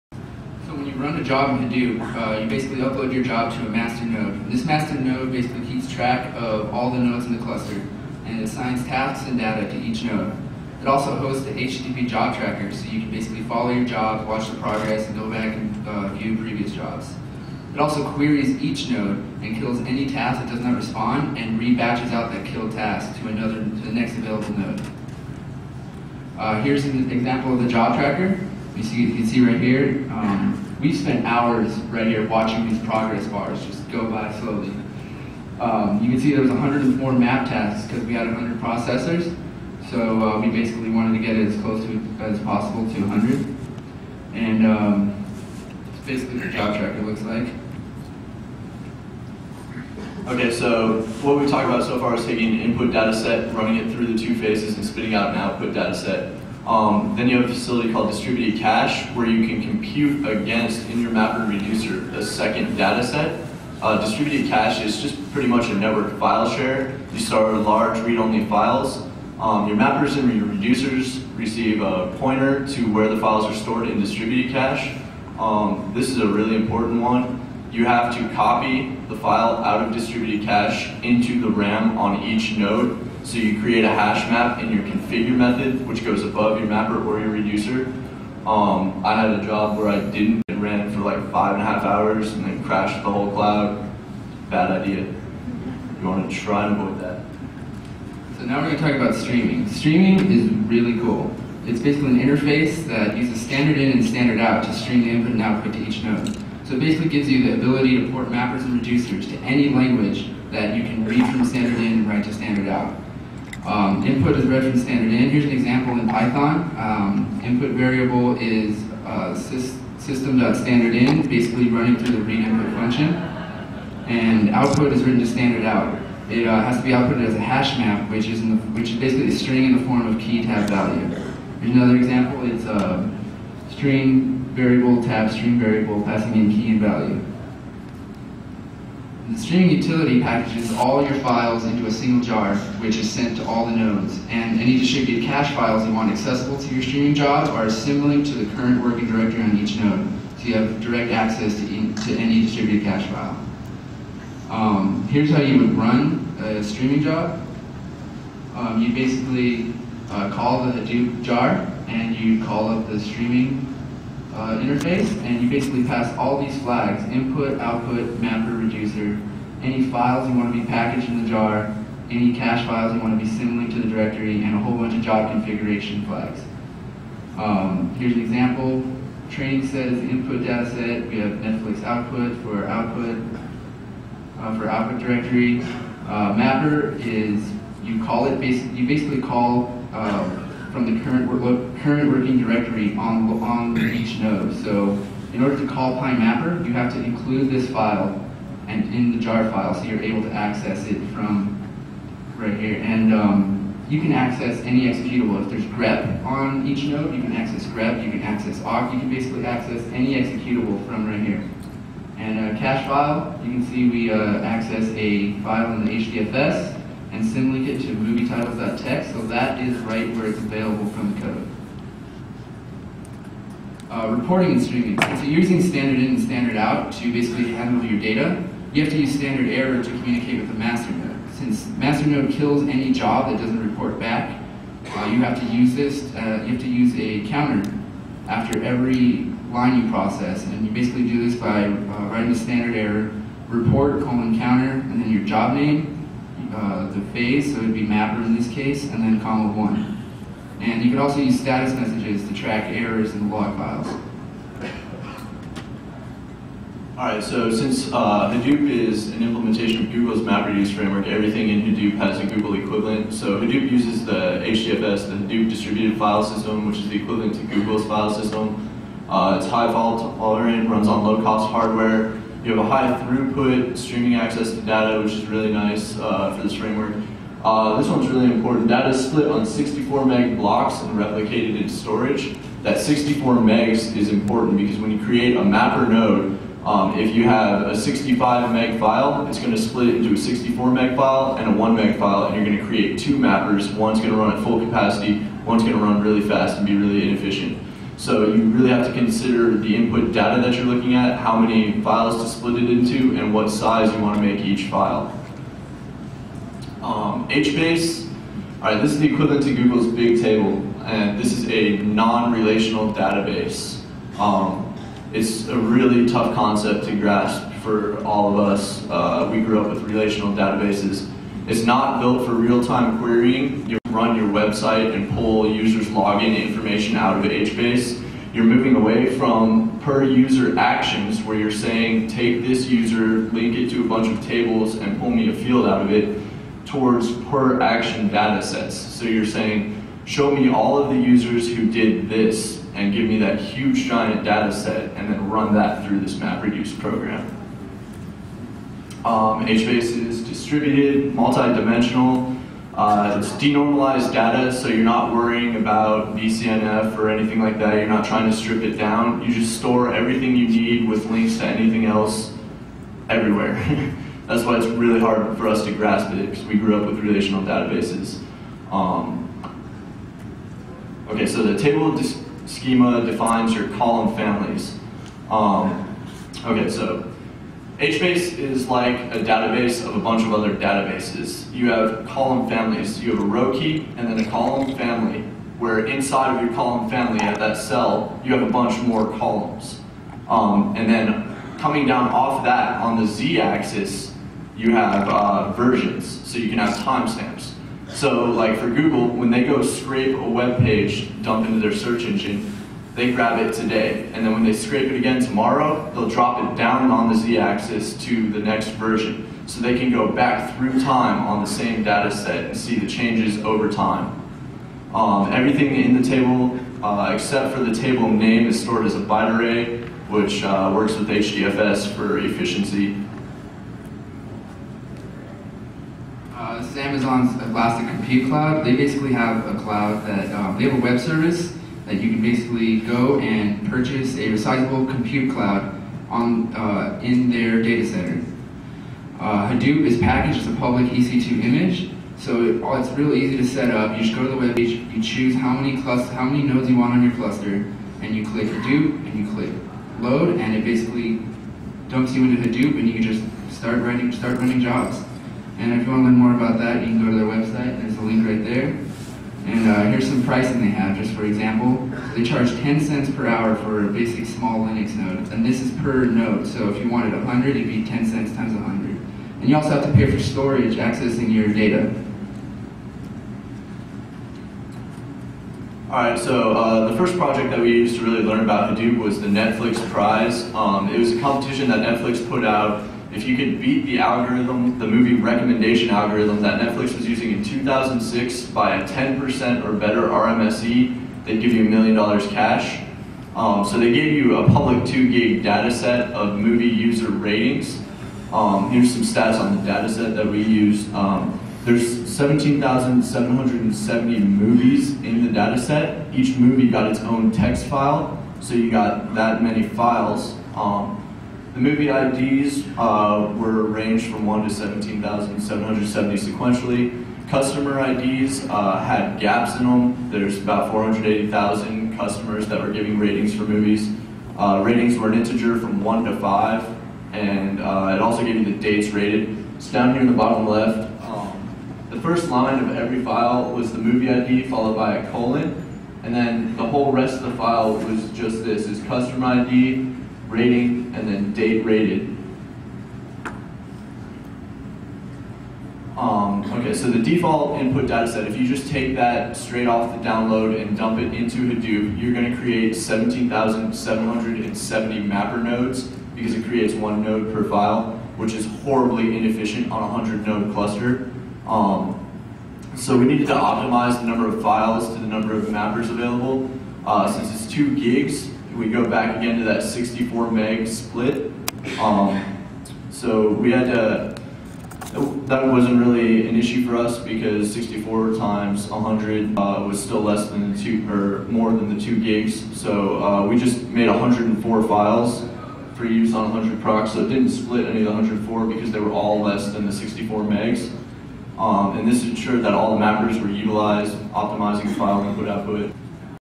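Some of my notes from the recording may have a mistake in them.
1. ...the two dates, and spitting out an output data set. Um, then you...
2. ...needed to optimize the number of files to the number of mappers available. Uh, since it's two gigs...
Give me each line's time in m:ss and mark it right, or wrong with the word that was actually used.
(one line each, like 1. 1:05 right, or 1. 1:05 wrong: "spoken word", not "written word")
1. 0:54 wrong: "phases", not "dates"
2. 9:23 right.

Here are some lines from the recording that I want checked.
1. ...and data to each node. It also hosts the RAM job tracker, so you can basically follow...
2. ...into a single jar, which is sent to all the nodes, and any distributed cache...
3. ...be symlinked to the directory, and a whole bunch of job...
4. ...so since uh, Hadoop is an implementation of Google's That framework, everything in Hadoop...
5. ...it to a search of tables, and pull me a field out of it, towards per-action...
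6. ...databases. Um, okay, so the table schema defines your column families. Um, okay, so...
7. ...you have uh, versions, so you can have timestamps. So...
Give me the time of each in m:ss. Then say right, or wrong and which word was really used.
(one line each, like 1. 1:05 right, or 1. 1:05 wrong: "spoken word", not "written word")
1. 0:09 wrong: "HTTP", not "RAM"
2. 2:21 right
3. 2:53 right
4. 4:17 wrong: "MapReduce", not "That"
5. 5:33 wrong: "bunch", not "search"
6. 6:07 right
7. 6:34 right.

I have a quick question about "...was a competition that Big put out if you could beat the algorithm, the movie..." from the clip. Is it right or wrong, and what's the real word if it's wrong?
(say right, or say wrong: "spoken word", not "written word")
wrong: "Netflix", not "Big".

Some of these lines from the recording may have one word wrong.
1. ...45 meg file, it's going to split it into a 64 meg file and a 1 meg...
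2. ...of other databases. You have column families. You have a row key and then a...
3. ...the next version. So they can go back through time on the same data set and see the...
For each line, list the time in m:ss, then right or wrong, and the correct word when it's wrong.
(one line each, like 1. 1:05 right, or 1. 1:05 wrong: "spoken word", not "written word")
1. 4:47 wrong: "65", not "45"
2. 6:20 right
3. 6:48 right.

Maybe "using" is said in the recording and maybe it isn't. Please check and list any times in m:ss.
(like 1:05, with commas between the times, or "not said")
3:45, 8:07.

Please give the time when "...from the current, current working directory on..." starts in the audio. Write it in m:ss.
3:10.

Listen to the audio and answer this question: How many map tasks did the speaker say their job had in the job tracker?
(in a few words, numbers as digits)
104.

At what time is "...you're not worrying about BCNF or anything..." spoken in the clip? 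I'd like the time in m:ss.
5:54.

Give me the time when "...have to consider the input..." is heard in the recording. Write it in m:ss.
4:58.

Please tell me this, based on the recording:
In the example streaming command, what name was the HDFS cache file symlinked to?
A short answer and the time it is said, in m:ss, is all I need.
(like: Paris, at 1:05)
movietitles.txt, at 3:37.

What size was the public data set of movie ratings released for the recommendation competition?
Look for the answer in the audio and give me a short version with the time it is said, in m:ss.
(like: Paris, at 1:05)
2 gig, at 8:14.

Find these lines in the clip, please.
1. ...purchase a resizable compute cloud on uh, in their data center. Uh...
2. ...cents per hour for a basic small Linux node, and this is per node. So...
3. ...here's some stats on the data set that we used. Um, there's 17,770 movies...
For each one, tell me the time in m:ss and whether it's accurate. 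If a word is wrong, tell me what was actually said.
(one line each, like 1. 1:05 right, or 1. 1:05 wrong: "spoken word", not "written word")
1. 7:13 right
2. 7:42 right
3. 8:18 right.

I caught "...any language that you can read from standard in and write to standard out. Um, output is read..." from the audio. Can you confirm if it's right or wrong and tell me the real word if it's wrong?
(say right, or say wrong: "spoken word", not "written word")
wrong: "input", not "output".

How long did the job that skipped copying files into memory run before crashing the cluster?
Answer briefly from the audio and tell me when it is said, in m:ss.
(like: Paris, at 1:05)
5.5 hours, at 1:31.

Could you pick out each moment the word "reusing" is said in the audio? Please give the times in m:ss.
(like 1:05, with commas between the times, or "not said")
not said.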